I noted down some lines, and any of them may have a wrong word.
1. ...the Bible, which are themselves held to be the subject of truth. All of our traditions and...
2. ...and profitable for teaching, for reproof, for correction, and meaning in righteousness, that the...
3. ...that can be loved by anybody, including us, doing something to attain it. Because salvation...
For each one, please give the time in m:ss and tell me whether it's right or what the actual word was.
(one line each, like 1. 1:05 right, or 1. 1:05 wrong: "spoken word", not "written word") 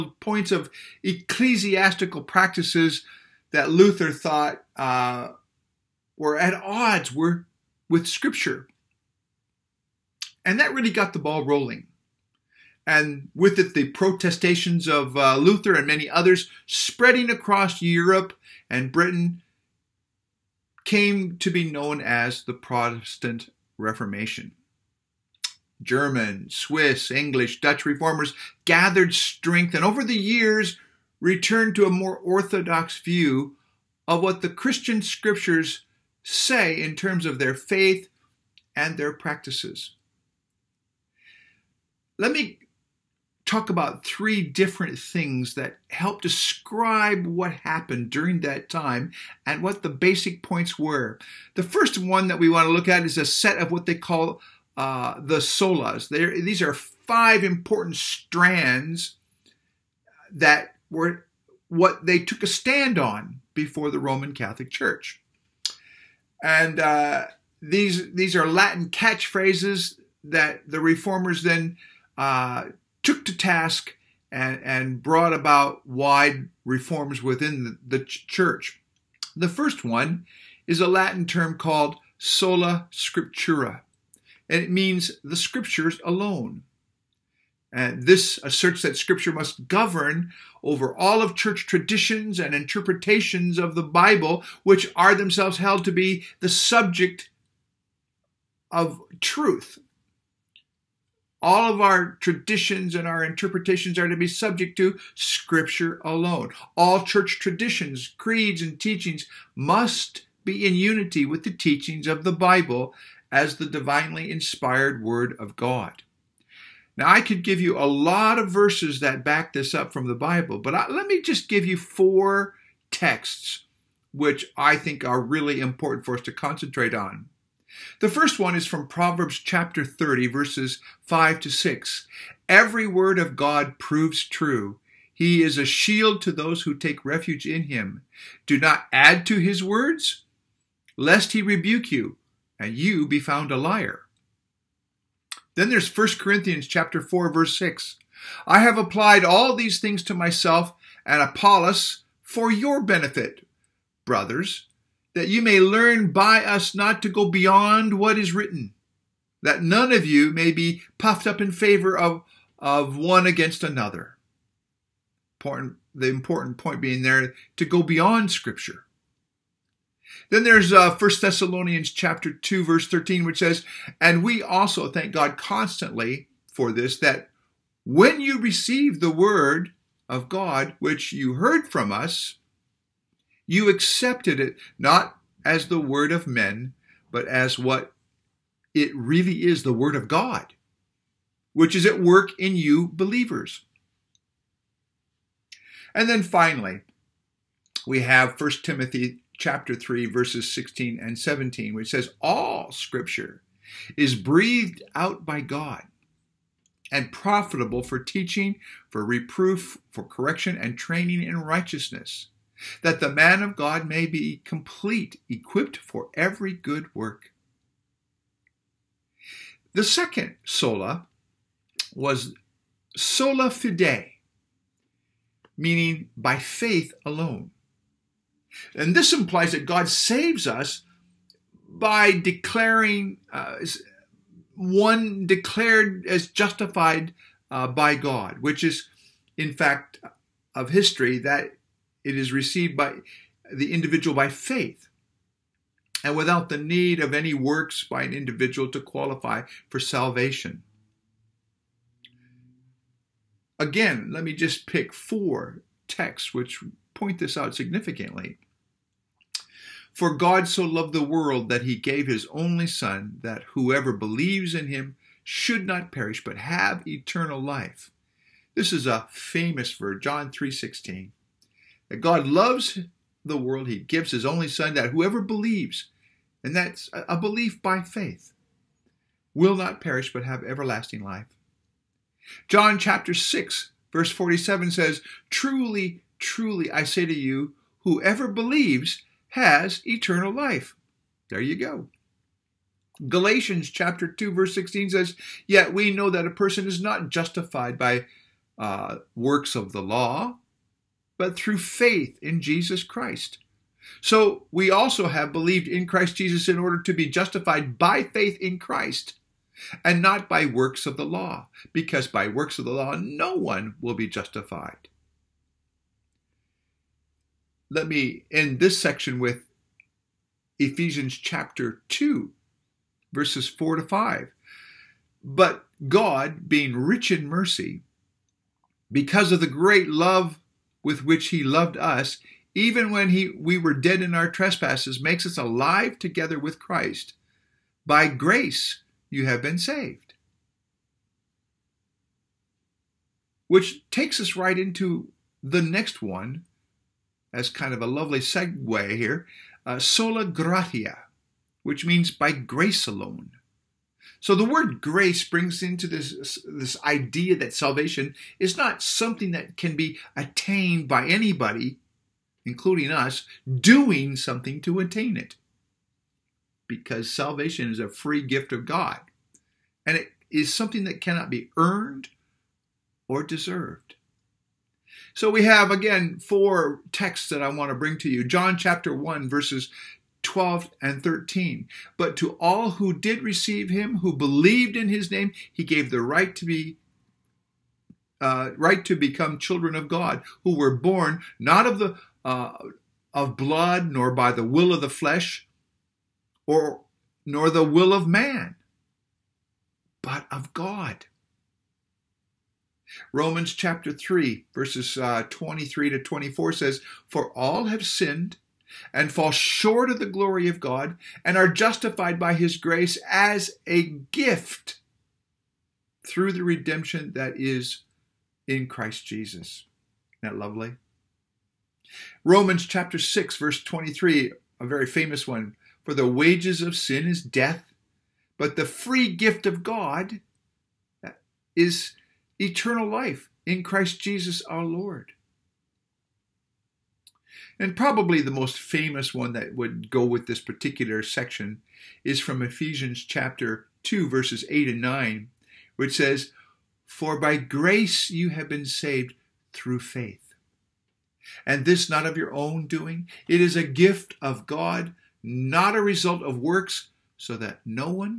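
1. 1:33 right
2. 3:26 wrong: "training", not "meaning"
3. 5:59 wrong: "attained", not "loved".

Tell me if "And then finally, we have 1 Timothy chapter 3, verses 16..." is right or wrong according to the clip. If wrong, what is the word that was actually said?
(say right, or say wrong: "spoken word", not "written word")
right.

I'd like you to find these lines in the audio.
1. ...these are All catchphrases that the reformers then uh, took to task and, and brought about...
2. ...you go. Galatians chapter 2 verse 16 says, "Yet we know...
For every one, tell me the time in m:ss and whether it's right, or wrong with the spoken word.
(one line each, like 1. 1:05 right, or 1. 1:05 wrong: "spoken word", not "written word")
1. 1:08 wrong: "Latin", not "All"
2. 4:51 right.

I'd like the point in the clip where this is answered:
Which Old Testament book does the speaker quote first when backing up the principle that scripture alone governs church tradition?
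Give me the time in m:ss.
2:08.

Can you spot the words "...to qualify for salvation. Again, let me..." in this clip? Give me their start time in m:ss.
4:08.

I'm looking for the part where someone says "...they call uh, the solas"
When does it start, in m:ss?
0:53.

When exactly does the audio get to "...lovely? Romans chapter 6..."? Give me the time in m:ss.
7:00.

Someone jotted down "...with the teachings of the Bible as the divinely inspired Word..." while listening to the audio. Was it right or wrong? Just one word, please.
right.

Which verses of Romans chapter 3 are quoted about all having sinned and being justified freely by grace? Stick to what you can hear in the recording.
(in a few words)
23 to 24.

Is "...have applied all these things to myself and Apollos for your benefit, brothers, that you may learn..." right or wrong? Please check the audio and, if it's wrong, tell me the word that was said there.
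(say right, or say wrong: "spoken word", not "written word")
right.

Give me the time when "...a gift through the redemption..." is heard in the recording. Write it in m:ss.
6:53.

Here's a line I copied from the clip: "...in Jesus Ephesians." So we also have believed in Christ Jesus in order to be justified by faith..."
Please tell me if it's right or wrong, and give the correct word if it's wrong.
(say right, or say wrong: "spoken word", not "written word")
wrong: "Christ", not "Ephesians".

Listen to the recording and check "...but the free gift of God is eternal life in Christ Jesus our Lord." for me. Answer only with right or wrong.
right.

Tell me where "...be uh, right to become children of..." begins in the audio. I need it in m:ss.
6:26.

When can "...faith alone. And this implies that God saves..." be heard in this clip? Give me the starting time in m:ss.
3:46.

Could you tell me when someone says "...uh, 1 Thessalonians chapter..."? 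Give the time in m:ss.
2:50.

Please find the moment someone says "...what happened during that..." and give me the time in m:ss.
0:47.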